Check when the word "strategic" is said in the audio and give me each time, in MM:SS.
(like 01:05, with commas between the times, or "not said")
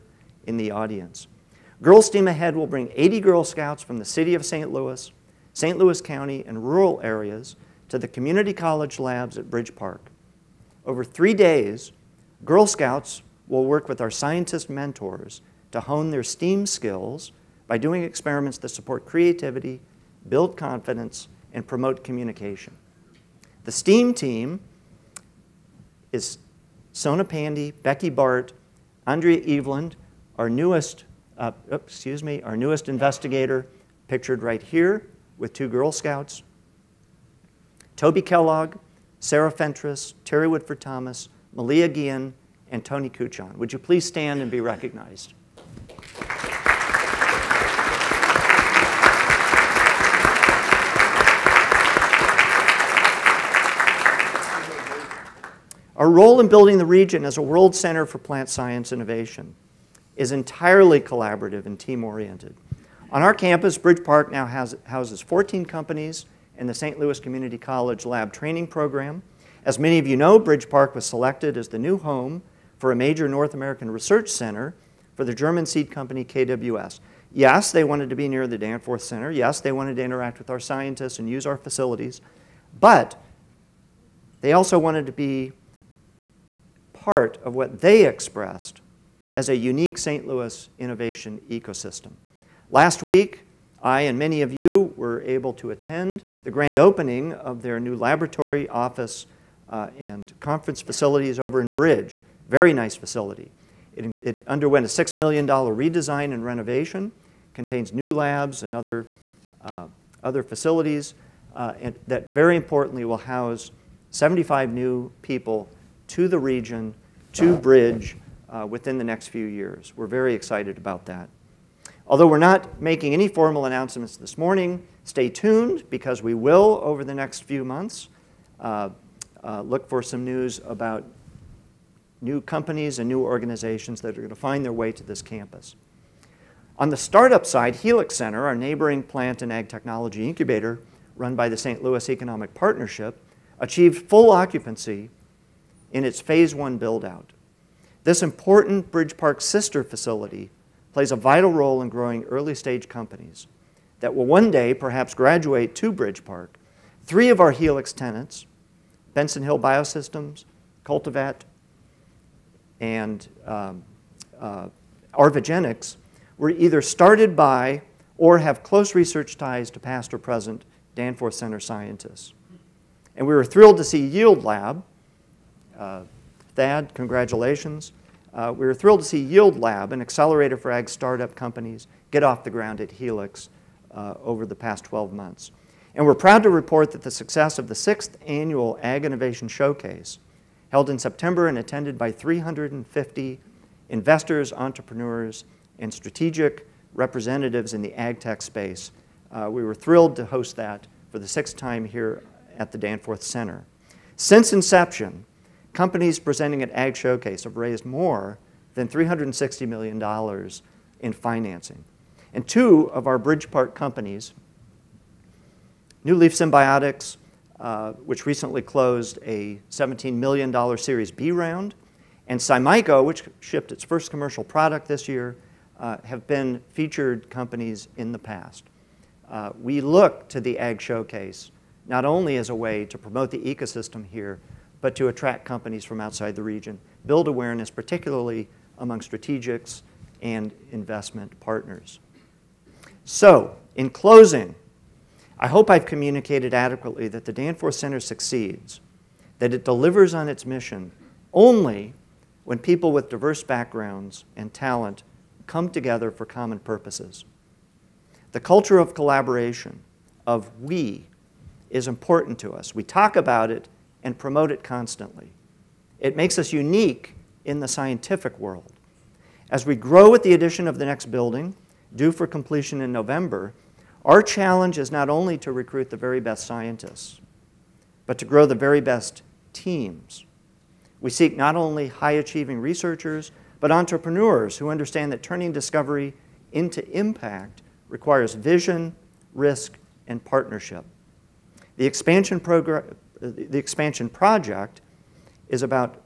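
03:15, 03:58.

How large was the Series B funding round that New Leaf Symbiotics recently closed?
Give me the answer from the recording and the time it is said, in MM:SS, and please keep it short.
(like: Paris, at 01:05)
$17 million, at 03:39.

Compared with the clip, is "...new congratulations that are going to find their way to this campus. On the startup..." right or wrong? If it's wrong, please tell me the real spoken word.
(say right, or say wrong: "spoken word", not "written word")
wrong: "organizations", not "congratulations".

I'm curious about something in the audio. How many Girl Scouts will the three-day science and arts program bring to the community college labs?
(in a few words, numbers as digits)
80.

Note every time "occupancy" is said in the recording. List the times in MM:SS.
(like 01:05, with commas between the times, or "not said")
02:24.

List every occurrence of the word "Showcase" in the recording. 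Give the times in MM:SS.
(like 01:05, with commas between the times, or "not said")
03:09, 03:26, 03:50.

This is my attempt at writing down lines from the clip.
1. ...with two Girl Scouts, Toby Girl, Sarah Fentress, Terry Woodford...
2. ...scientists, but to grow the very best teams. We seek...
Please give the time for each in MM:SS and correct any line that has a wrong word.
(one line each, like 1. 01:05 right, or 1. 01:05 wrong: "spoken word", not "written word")
1. 00:35 wrong: "Kellogg", not "Girl"
2. 04:36 right.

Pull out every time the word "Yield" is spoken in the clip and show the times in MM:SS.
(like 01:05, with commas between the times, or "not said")
02:54, 02:59.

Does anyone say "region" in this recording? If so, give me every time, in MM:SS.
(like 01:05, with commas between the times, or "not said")
00:56, 01:56, 03:56.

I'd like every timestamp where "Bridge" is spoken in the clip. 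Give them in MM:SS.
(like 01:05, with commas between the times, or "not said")
00:09, 01:03, 01:10, 01:41, 01:57, 02:28, 02:35, 03:33.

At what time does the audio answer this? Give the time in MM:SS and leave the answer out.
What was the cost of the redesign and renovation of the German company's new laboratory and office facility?
01:44.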